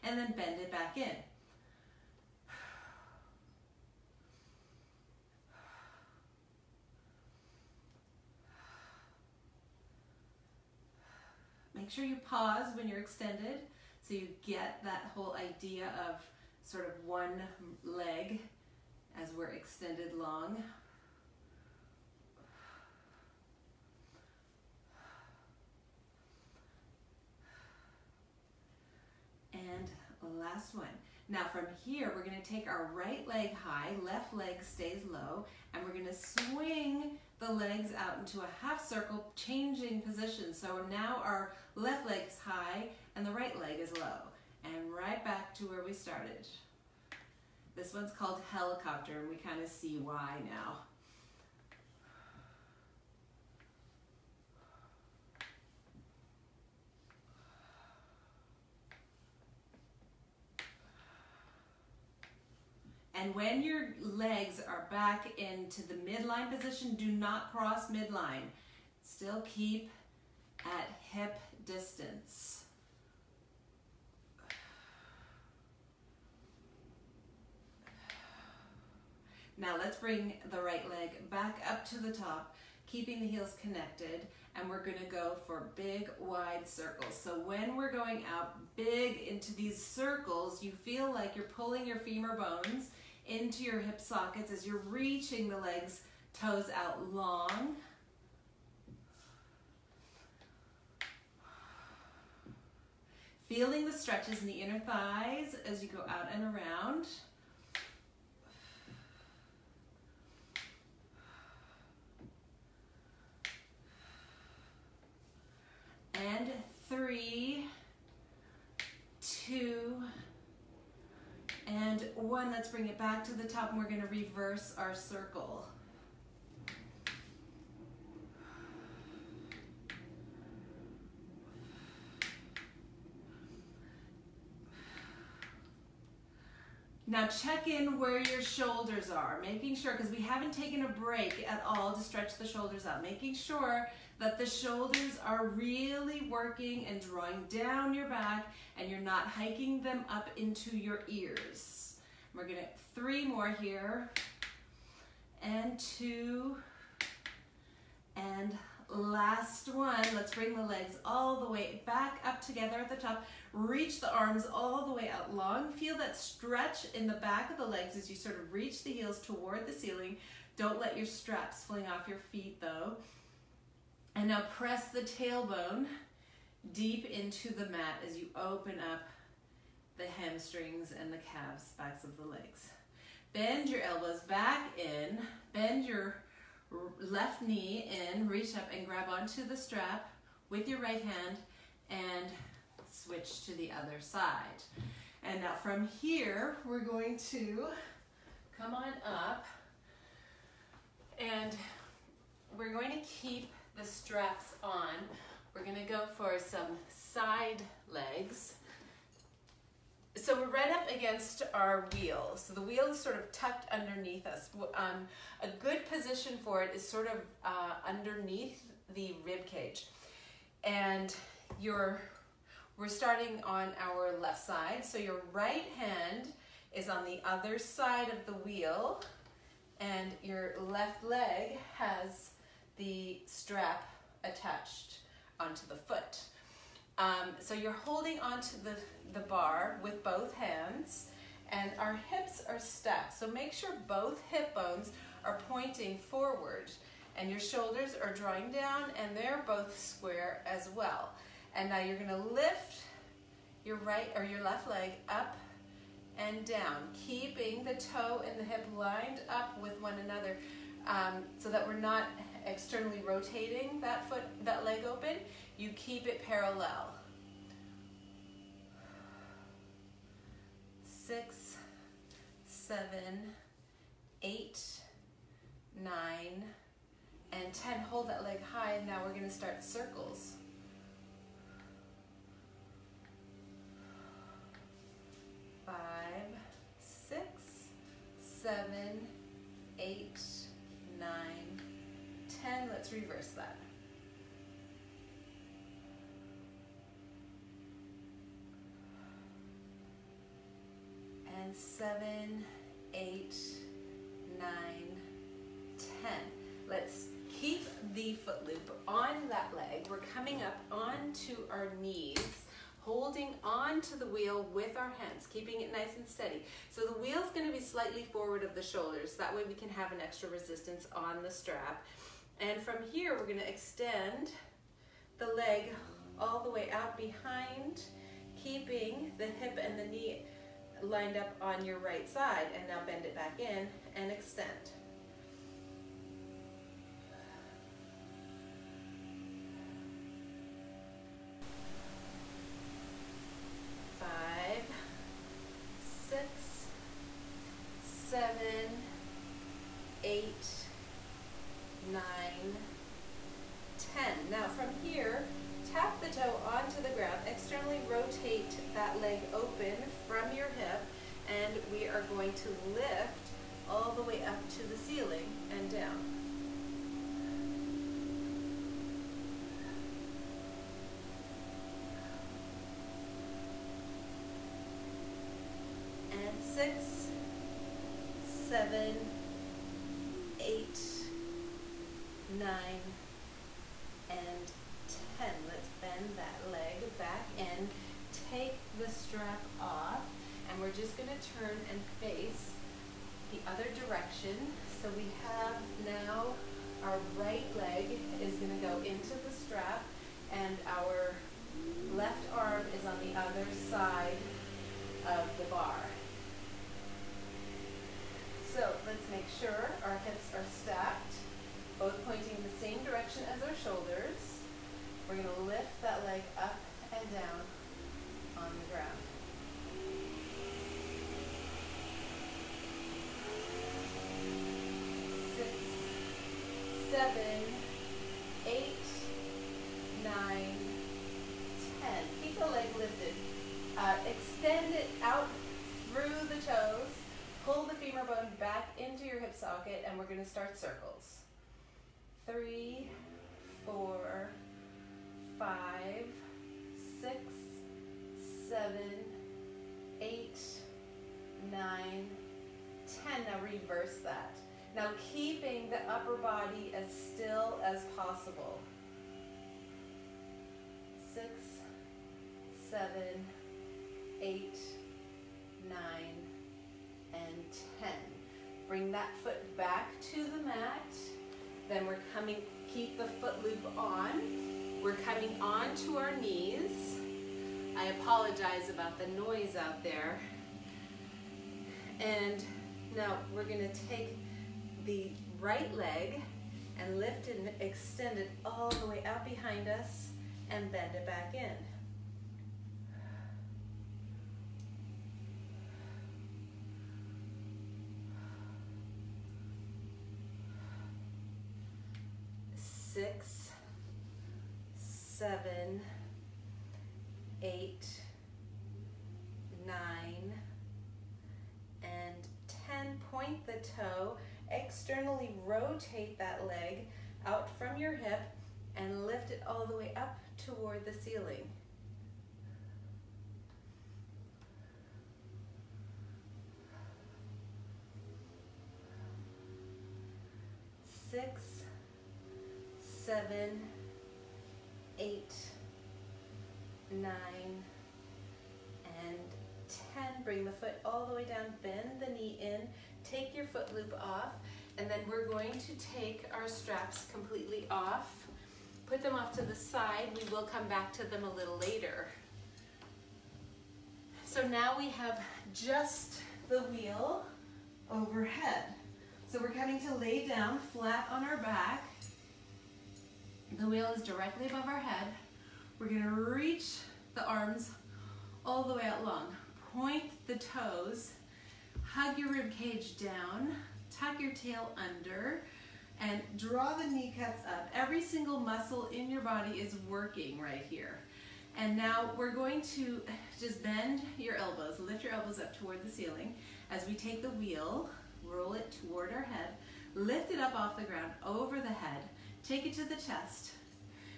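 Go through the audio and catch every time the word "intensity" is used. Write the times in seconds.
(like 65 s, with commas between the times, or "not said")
not said.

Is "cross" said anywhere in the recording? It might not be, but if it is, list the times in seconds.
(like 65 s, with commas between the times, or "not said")
67 s.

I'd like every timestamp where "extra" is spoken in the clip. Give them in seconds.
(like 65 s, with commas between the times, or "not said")
320 s.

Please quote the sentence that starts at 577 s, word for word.
Every single muscle in your body is working right here.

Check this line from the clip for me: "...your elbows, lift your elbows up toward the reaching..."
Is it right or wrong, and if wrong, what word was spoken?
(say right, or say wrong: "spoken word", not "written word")
wrong: "ceiling", not "reaching".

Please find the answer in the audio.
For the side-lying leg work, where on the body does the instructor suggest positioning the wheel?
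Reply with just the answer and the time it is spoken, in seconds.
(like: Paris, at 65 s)
underneath the rib cage, at 217 s.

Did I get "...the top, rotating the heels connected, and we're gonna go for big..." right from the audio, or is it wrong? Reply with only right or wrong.
wrong.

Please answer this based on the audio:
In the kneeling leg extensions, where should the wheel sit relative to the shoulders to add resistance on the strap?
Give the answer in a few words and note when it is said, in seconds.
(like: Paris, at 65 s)
slightly forward, at 317 s.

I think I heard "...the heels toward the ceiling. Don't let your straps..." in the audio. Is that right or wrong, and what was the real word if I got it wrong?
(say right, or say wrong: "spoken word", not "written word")
right.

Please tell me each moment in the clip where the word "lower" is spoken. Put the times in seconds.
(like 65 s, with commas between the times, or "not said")
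not said.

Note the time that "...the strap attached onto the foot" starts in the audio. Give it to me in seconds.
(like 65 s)
232 s.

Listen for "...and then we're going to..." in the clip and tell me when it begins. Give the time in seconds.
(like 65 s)
544 s.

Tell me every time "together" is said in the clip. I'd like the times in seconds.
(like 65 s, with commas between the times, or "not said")
162 s.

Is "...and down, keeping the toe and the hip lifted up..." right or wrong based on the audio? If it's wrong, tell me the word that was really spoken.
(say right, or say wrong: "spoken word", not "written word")
wrong: "lined", not "lifted".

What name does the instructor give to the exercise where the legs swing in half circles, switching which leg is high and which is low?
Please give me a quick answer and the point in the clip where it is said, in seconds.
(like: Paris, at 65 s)
helicopter, at 48 s.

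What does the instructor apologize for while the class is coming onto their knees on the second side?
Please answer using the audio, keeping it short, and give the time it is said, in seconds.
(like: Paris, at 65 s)
the noise, at 478 s.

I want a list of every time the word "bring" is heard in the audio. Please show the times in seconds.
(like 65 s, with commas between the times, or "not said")
79 s, 122 s, 160 s, 468 s.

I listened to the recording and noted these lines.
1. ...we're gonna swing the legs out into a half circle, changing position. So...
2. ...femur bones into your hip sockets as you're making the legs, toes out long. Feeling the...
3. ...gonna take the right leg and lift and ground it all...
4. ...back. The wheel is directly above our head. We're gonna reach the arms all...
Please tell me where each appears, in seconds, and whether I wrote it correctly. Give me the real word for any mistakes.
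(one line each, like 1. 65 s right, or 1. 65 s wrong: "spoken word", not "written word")
1. 35 s right
2. 92 s wrong: "reaching", not "making"
3. 483 s wrong: "extend", not "ground"
4. 561 s right.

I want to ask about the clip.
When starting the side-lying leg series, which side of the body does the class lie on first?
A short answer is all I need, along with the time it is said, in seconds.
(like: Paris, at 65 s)
left side, at 224 s.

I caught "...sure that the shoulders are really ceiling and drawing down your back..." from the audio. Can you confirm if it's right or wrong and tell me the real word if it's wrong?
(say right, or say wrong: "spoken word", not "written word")
wrong: "working", not "ceiling".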